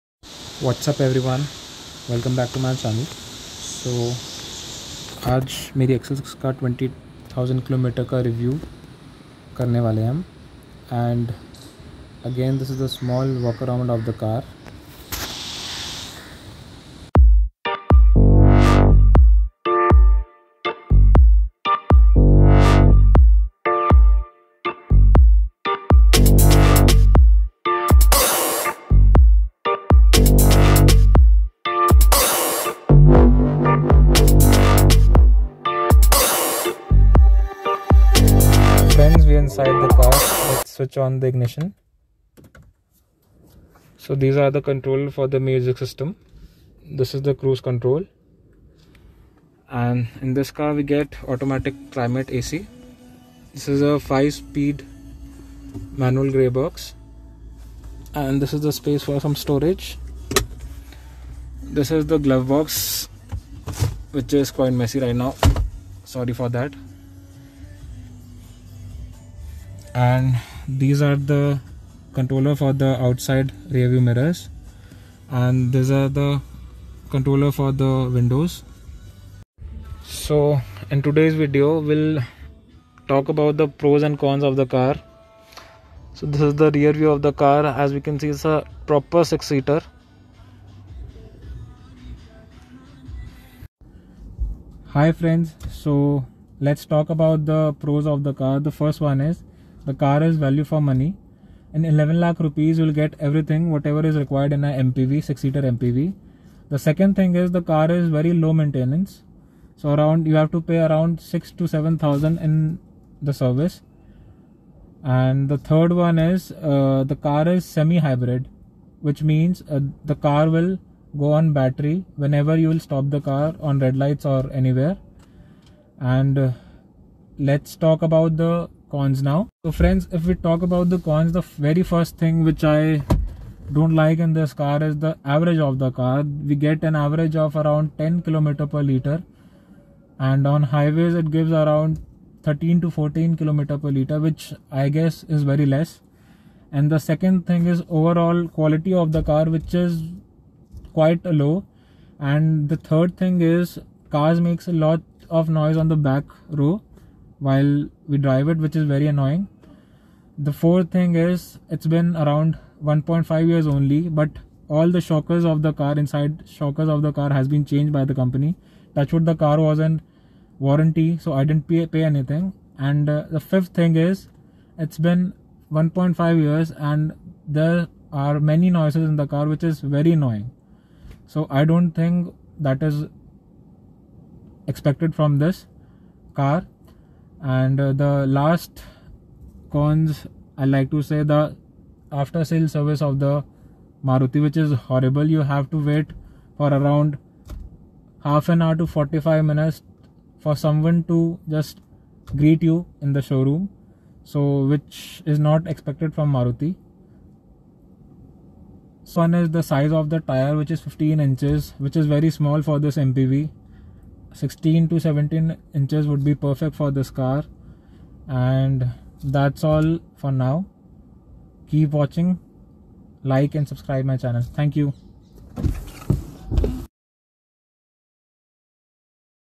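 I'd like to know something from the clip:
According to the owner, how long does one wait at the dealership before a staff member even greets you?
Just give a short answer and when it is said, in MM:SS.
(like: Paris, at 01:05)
half an hour to 45 minutes, at 03:18.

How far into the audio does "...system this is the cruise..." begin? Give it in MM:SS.
00:45.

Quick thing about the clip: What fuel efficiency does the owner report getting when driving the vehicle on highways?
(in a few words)
13 to 14 km per liter.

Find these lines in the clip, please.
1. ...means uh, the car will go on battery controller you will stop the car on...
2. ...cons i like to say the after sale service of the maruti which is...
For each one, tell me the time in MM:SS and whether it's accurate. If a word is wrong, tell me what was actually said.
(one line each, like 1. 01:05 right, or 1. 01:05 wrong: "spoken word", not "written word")
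1. 01:59 wrong: "whenever", not "controller"
2. 03:09 right.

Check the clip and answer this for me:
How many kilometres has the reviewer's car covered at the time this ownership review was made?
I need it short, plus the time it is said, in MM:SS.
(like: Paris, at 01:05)
20000 km, at 00:06.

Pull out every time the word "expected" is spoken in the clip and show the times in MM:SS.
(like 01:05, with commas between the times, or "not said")
03:04, 03:25.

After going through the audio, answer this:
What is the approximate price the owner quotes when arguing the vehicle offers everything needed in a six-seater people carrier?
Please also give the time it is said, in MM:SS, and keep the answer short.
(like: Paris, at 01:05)
11 lakh rupees, at 01:41.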